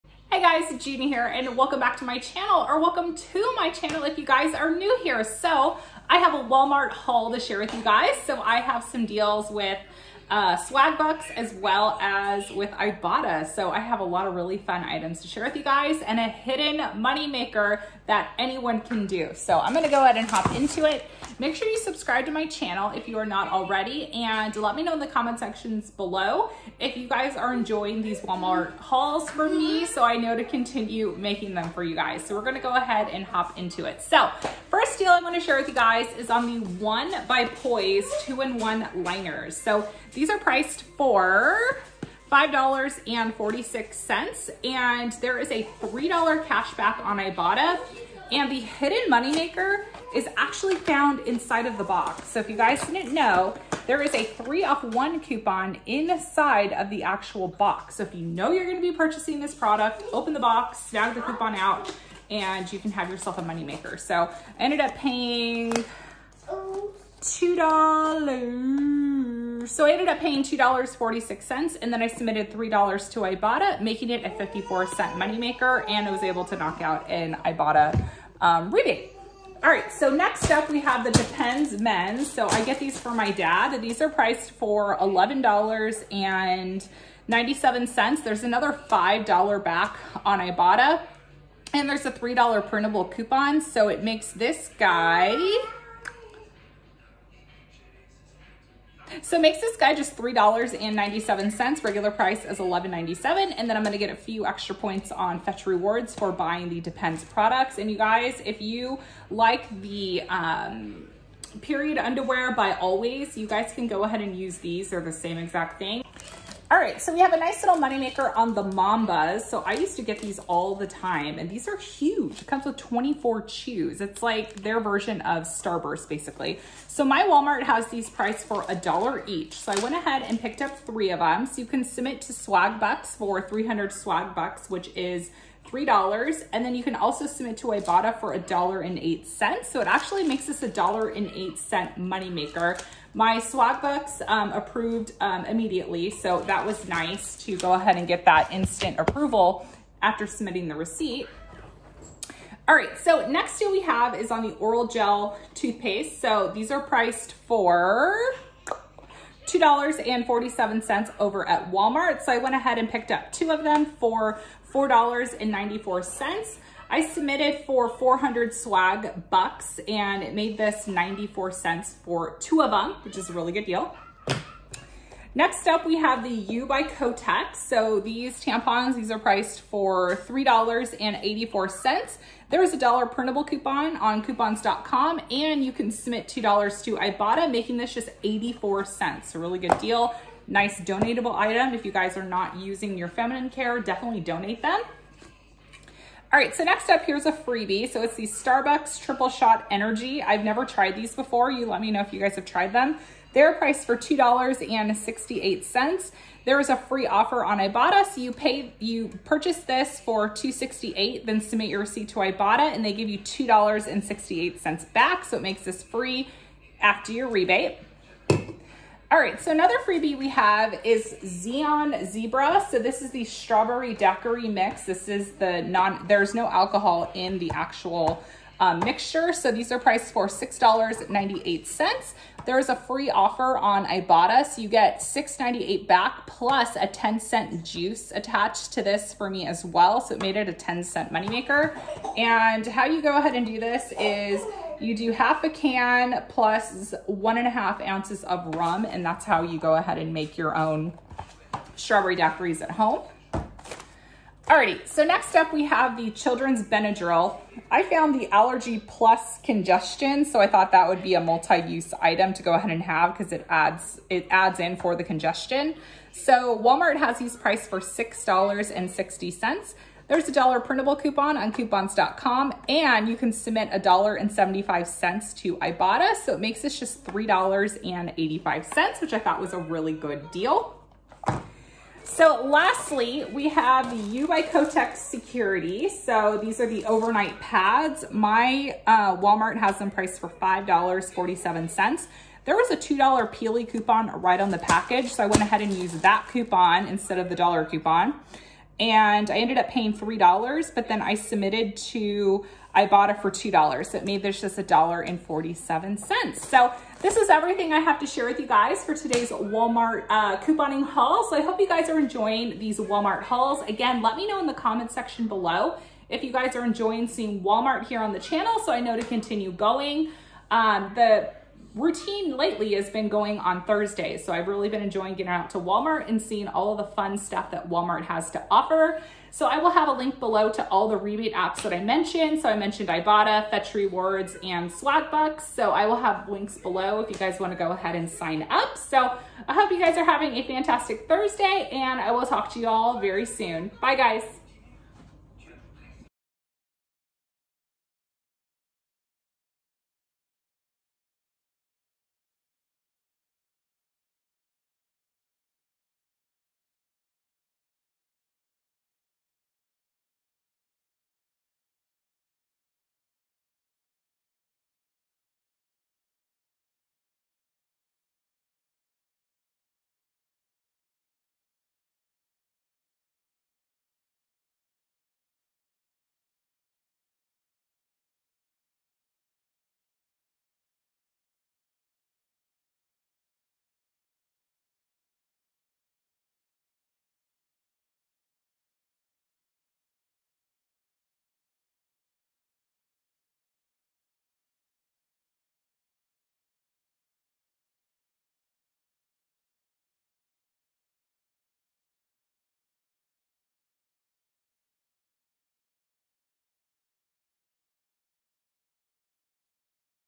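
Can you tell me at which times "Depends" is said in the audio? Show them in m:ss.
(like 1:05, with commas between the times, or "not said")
1:21, 1:46.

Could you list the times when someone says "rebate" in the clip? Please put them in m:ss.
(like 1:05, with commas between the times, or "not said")
1:18, 3:37, 5:30.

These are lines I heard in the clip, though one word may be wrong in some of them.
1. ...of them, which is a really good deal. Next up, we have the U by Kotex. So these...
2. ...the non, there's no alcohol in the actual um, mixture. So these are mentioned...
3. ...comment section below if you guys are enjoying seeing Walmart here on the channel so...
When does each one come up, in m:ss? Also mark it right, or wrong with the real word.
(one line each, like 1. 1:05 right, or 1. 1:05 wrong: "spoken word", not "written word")
1. 2:52 right
2. 3:45 wrong: "priced", not "mentioned"
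3. 5:14 right.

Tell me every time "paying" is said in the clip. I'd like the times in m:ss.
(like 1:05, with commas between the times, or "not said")
1:04, 1:10, 4:59.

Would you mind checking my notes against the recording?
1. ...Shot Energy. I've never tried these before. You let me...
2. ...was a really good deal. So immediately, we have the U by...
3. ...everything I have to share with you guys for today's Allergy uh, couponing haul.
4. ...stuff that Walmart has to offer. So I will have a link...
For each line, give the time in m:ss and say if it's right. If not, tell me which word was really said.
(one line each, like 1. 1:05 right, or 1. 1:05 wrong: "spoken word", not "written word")
1. 3:19 right
2. 4:39 wrong: "lastly", not "immediately"
3. 5:07 wrong: "Walmart", not "Allergy"
4. 5:27 right.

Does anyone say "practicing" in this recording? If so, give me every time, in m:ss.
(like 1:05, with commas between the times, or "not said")
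not said.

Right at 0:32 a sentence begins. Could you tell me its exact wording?
So we're gonna go ahead and hop into it.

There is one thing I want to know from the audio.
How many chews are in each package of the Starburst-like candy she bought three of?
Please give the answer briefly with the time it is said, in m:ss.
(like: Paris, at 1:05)
24, at 2:02.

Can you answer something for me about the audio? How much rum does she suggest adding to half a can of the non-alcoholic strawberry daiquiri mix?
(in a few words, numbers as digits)
1.5 ounces.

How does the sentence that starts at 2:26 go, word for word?
So that was nice to go ahead and get that instant approval after submitting the receipt.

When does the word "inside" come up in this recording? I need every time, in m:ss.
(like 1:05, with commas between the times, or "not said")
0:51, 0:55.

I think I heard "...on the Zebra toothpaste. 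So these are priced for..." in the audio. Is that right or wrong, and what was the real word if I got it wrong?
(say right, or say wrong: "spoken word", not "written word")
wrong: "Orajel", not "Zebra".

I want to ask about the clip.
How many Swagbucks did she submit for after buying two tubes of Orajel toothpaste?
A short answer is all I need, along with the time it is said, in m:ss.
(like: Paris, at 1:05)
400, at 2:47.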